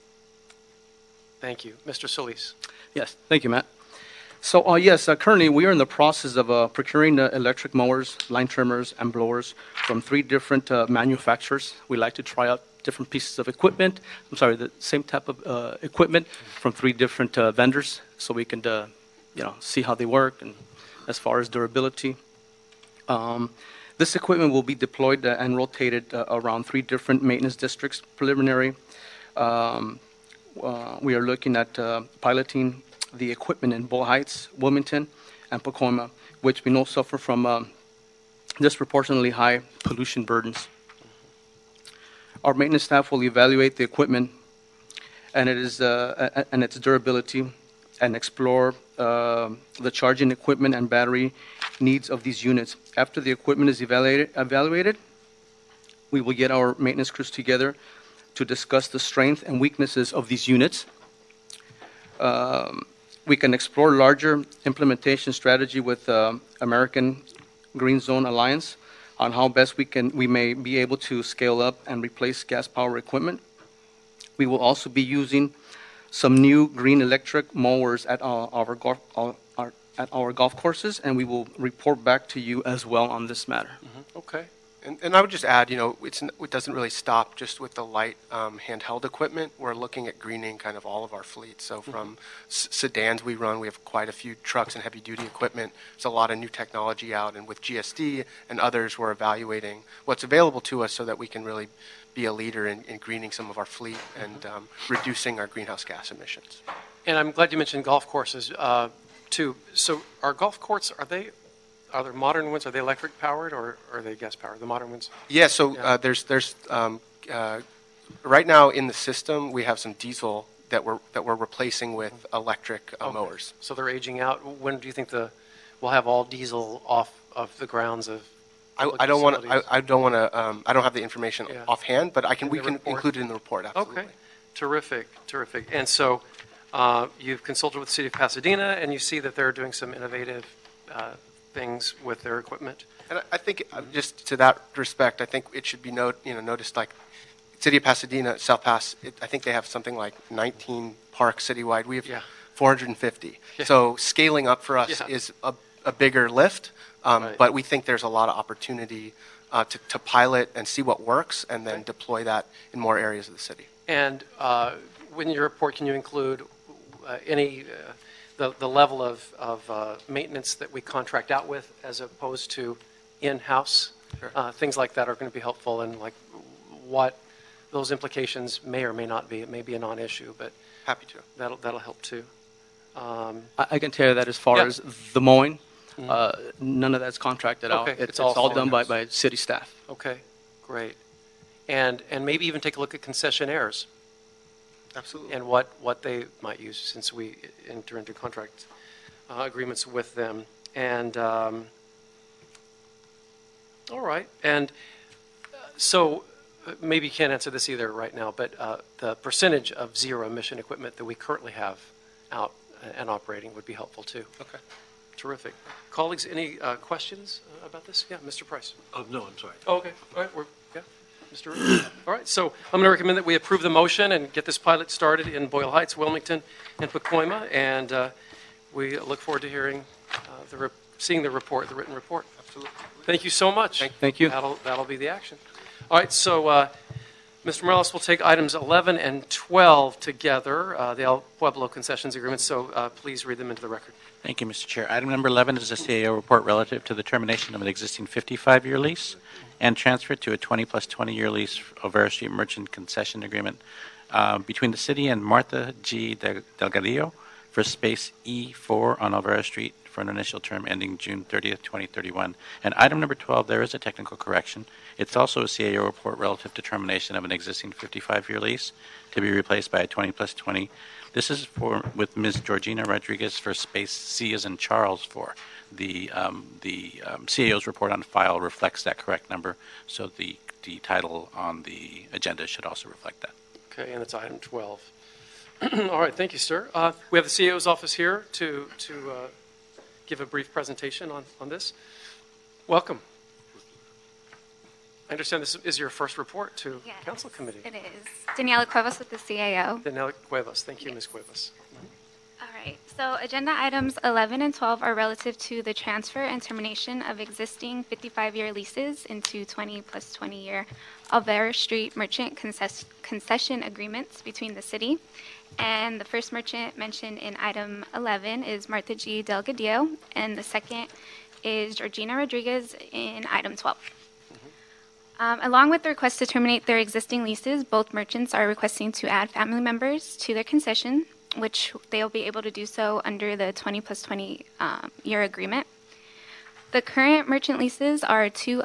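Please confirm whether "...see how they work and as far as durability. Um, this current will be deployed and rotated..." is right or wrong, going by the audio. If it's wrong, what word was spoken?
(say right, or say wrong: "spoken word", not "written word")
wrong: "equipment", not "current".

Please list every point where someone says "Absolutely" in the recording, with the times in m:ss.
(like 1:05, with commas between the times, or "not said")
2:13, 3:14, 3:52.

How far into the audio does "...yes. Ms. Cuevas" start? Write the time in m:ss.
5:00.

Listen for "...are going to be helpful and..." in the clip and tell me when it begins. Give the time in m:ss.
2:55.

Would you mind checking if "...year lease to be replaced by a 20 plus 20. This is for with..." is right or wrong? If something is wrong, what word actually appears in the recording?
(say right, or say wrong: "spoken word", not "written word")
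right.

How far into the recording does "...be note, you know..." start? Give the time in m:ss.
2:25.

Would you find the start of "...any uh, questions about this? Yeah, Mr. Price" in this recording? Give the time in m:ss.
3:36.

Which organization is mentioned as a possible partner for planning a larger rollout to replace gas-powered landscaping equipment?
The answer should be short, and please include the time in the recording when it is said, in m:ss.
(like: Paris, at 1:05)
American Green Zone Alliance, at 1:06.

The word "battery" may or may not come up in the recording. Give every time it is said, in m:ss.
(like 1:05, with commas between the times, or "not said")
0:50.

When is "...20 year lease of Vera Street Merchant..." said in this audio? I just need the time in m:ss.
4:10.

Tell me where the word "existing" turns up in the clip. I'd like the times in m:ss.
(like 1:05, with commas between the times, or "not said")
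4:07, 4:27, 5:07, 5:26.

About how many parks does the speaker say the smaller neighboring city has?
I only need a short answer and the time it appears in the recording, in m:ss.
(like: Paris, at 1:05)
19, at 2:30.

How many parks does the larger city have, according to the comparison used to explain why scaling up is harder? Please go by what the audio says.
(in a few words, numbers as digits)
450.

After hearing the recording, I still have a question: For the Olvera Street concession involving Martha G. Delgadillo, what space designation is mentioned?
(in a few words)
E4.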